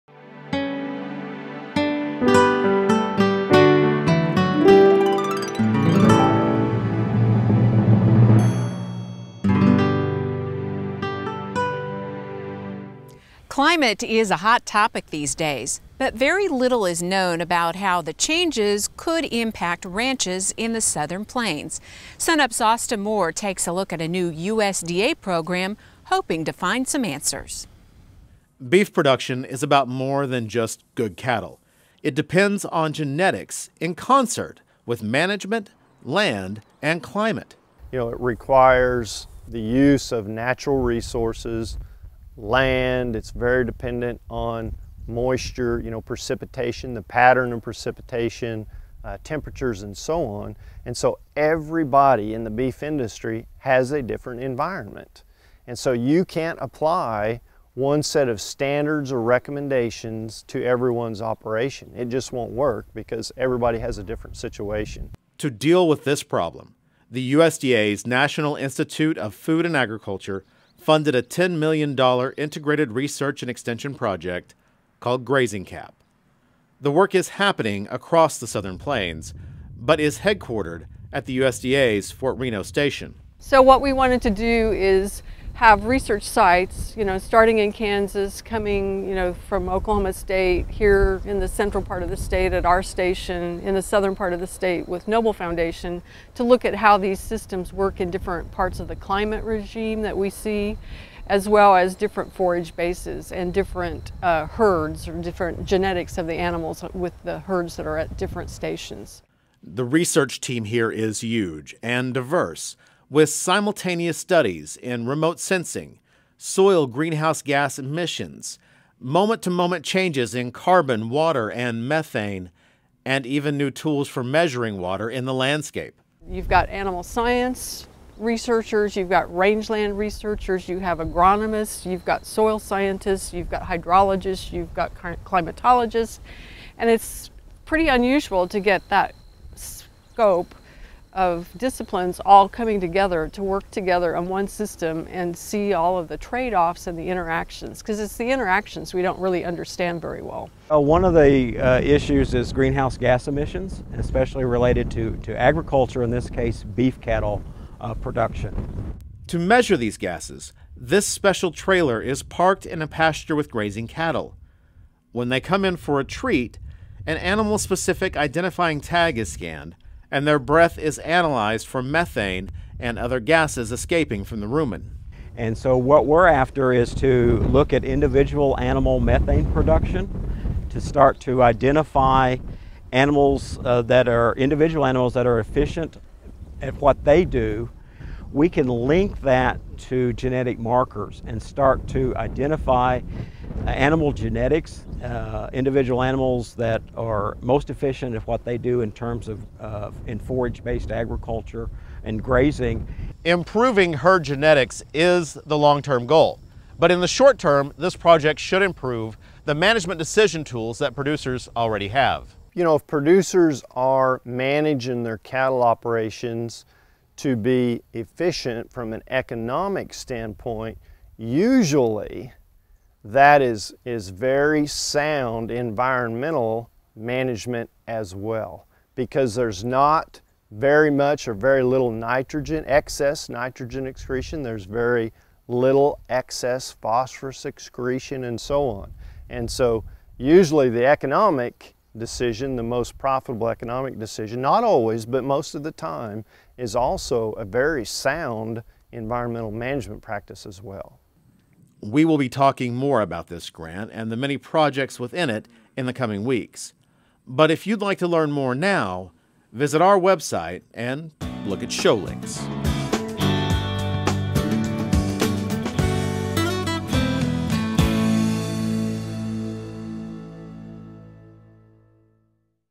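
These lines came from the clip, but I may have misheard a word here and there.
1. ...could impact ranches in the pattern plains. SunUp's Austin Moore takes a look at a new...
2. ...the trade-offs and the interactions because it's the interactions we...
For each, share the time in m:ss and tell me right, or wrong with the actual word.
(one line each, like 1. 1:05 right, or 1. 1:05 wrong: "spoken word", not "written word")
1. 0:18 wrong: "southern", not "pattern"
2. 2:26 right.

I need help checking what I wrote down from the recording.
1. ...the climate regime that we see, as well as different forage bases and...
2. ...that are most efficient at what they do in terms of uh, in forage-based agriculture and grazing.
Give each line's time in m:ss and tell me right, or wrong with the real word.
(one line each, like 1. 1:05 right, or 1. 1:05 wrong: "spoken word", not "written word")
1. 1:38 right
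2. 3:16 right.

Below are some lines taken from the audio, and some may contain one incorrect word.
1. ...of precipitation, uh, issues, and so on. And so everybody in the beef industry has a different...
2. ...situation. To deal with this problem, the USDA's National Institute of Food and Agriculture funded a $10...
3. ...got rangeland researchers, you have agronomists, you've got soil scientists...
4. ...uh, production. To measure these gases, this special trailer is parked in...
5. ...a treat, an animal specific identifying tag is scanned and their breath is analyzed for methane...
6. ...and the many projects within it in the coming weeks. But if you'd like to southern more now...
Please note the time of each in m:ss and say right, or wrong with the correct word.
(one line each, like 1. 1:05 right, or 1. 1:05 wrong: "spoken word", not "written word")
1. 0:47 wrong: "temperatures", not "issues"
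2. 1:04 right
3. 2:09 right
4. 2:37 right
5. 2:45 right
6. 4:13 wrong: "learn", not "southern".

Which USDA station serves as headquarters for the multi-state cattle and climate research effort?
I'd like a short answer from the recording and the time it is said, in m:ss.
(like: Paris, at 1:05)
Fort Reno, at 1:22.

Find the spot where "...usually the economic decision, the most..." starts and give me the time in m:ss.
4:00.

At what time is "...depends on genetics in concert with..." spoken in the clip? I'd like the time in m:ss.
0:32.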